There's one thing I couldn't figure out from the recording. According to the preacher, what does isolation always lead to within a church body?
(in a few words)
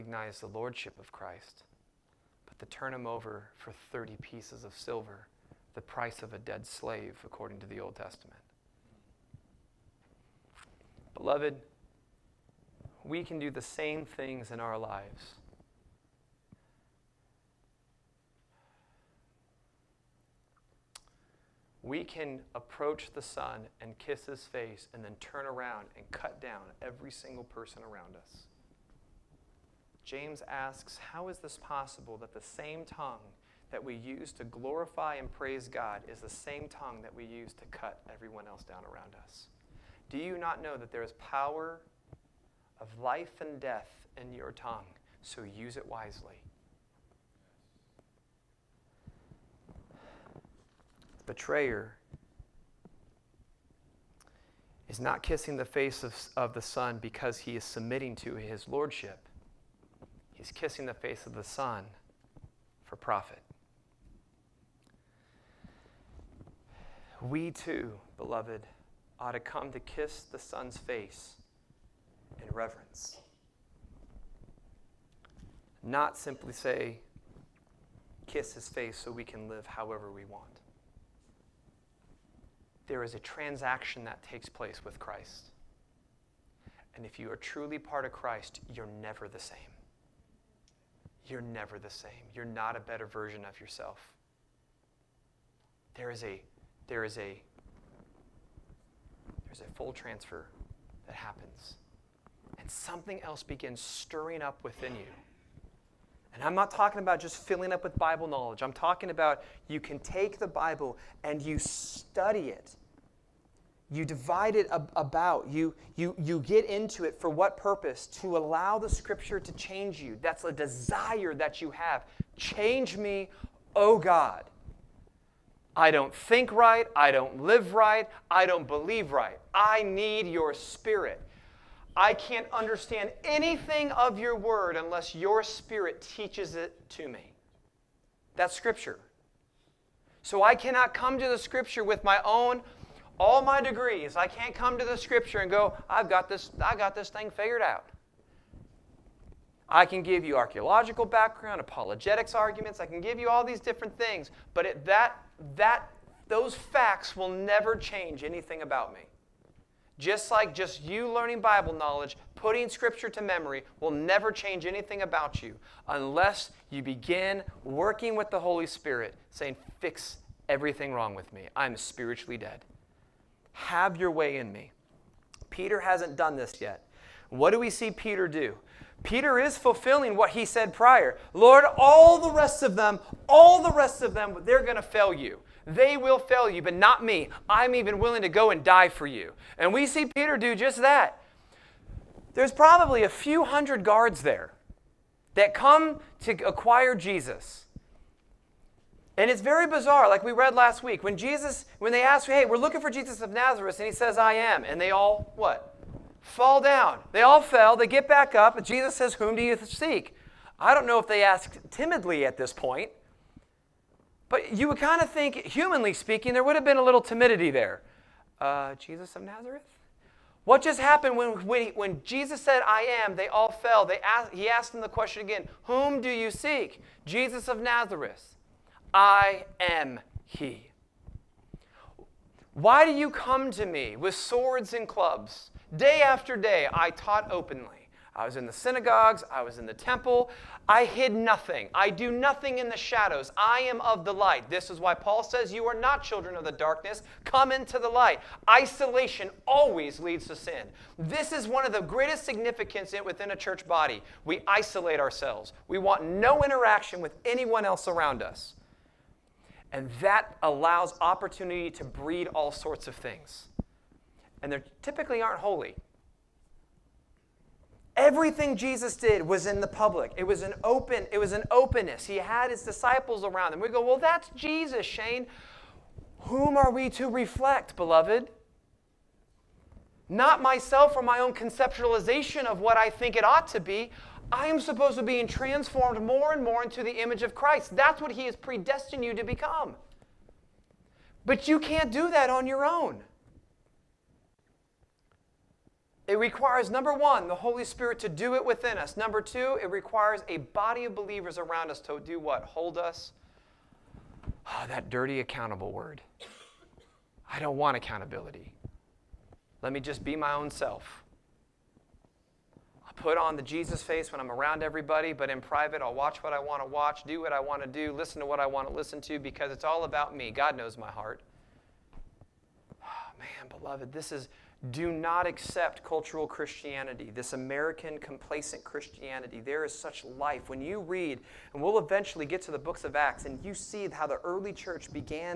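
Sin.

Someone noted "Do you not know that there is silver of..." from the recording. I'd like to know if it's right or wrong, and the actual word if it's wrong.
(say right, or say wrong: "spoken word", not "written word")
wrong: "power", not "silver".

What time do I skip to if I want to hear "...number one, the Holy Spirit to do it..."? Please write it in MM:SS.
04:56.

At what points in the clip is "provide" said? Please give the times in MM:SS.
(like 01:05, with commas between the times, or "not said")
not said.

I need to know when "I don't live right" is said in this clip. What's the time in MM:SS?
02:06.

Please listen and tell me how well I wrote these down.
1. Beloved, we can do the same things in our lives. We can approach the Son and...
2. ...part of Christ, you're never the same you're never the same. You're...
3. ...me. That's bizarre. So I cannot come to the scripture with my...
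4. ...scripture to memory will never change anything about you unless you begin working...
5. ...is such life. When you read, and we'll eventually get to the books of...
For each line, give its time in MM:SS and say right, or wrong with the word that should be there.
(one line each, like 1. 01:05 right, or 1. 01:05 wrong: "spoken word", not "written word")
1. 00:11 right
2. 01:27 right
3. 02:17 wrong: "scripture", not "bizarre"
4. 02:42 right
5. 05:29 right.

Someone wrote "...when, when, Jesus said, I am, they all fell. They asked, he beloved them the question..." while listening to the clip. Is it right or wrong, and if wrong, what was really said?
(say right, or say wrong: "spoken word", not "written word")
wrong: "asked", not "beloved".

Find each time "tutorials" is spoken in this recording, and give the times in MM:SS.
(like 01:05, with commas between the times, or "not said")
not said.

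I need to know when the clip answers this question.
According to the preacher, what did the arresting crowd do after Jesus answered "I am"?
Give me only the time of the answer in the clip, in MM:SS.
03:26.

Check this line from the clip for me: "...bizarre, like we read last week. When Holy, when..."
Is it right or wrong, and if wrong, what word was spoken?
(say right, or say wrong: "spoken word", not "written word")
wrong: "Jesus", not "Holy".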